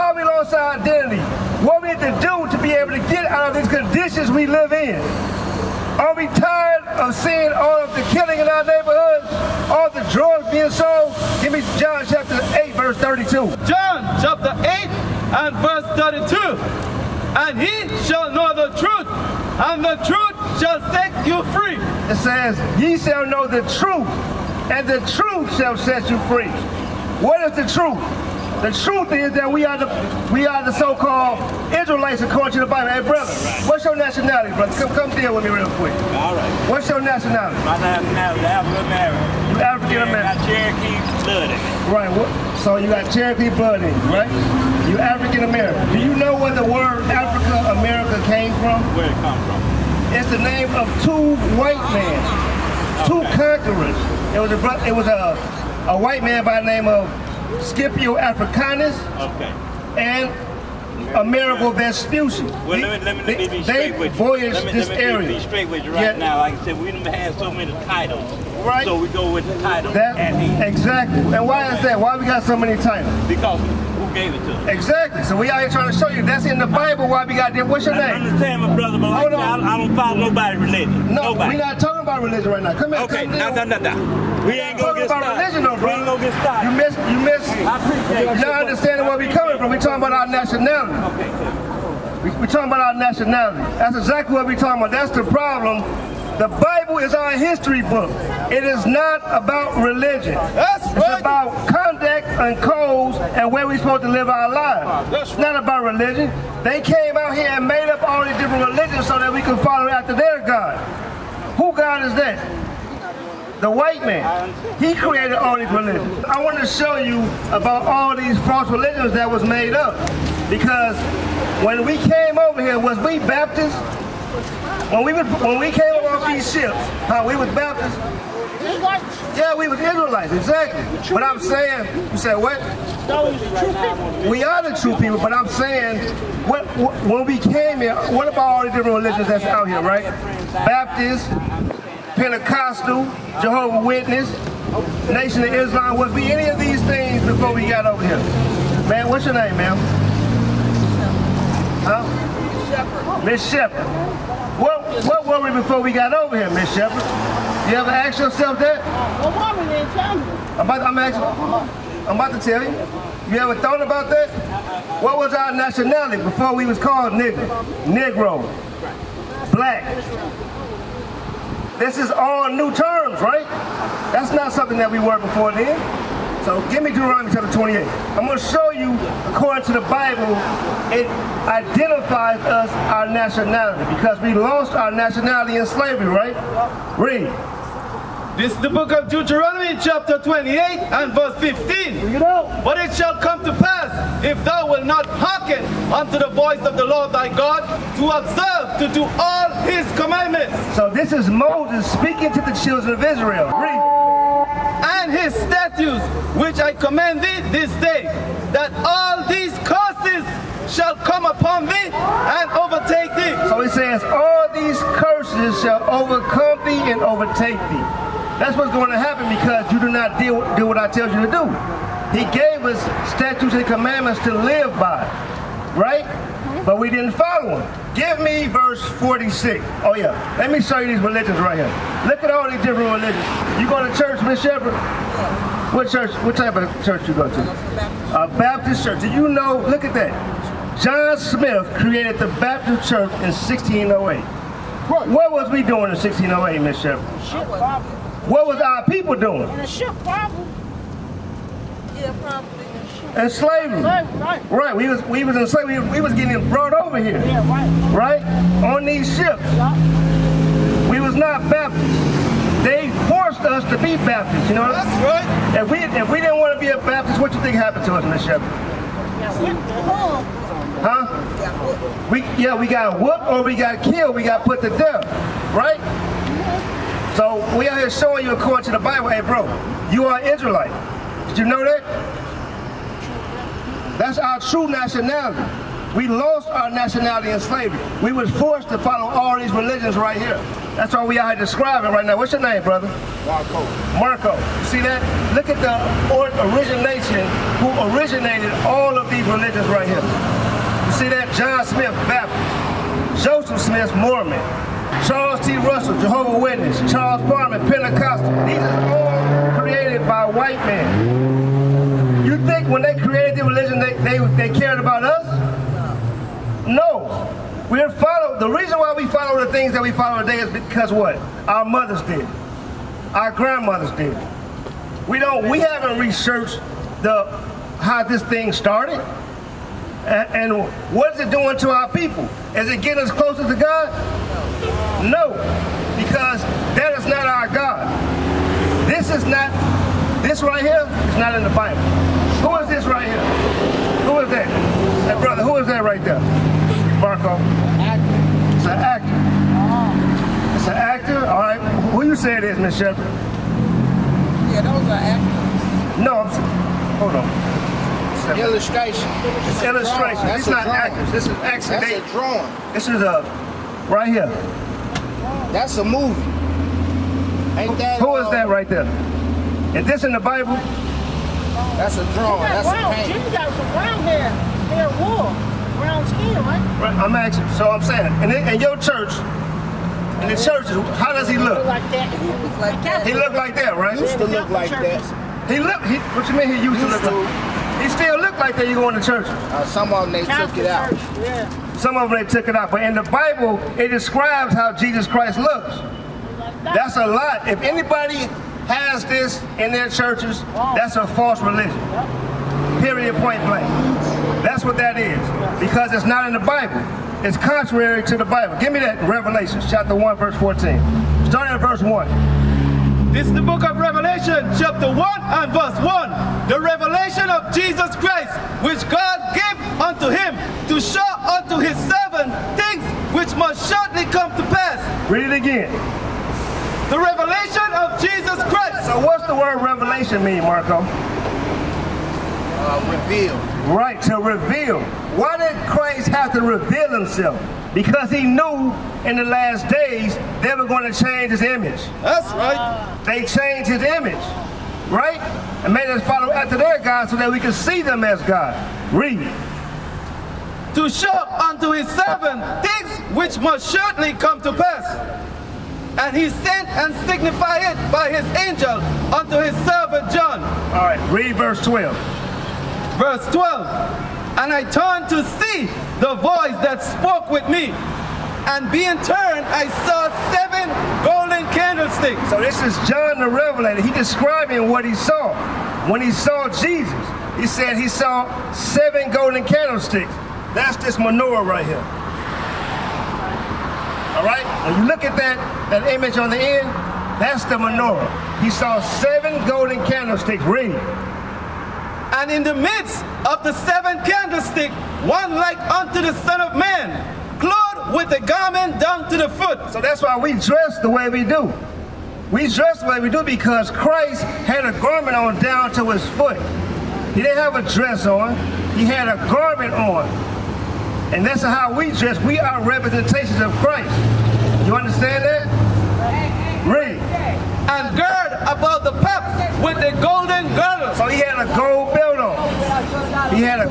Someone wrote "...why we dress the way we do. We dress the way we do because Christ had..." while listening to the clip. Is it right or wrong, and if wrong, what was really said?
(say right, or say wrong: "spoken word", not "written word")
right.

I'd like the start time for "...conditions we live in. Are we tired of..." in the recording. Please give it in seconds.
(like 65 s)
3 s.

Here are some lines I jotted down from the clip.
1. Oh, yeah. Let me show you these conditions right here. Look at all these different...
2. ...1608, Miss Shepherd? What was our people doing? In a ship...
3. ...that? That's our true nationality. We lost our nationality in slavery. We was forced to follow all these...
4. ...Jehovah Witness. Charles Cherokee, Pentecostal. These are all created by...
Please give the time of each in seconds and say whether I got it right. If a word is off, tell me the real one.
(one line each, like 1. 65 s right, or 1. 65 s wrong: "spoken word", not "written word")
1. 229 s wrong: "religions", not "conditions"
2. 245 s right
3. 281 s right
4. 305 s wrong: "Farman", not "Cherokee".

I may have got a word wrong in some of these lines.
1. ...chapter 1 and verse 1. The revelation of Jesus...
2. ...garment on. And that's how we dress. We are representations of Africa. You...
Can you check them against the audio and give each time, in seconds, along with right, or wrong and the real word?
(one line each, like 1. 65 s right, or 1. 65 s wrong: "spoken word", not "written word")
1. 414 s right
2. 509 s wrong: "Christ", not "Africa".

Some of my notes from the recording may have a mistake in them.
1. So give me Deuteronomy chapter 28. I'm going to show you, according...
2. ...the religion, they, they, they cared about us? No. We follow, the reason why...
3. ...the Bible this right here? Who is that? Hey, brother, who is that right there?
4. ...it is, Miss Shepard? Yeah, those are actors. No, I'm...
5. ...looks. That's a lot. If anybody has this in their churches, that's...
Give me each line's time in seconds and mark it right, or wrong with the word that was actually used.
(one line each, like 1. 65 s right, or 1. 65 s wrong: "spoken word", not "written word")
1. 176 s right
2. 313 s right
3. 341 s right
4. 352 s right
5. 395 s right.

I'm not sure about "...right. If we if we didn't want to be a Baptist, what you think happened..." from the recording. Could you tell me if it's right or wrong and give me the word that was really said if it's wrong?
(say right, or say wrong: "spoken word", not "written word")
right.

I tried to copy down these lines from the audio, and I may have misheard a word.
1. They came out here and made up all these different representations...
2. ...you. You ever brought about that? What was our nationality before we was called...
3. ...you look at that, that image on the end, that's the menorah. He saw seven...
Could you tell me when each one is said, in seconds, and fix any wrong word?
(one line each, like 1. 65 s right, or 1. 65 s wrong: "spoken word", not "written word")
1. 106 s wrong: "religions", not "representations"
2. 162 s wrong: "thought", not "brought"
3. 484 s right.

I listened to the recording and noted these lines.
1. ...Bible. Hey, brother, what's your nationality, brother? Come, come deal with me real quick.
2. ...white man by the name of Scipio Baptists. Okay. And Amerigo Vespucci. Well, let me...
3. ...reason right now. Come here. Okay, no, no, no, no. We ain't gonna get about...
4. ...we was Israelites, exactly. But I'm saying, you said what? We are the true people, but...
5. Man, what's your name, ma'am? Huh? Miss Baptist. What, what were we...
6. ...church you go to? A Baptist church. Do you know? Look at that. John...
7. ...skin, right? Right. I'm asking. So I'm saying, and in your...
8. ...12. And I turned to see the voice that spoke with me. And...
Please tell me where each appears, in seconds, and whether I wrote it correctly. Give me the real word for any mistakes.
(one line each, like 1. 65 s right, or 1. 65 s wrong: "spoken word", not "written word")
1. 32 s right
2. 55 s wrong: "Africanus", not "Baptists"
3. 82 s wrong: "religion", not "reason"
4. 129 s right
5. 148 s wrong: "Shepard", not "Baptist"
6. 236 s right
7. 376 s right
8. 463 s right.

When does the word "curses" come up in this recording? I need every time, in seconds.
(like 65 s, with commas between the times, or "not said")
209 s, 215 s.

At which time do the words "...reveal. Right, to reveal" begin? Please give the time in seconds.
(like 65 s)
432 s.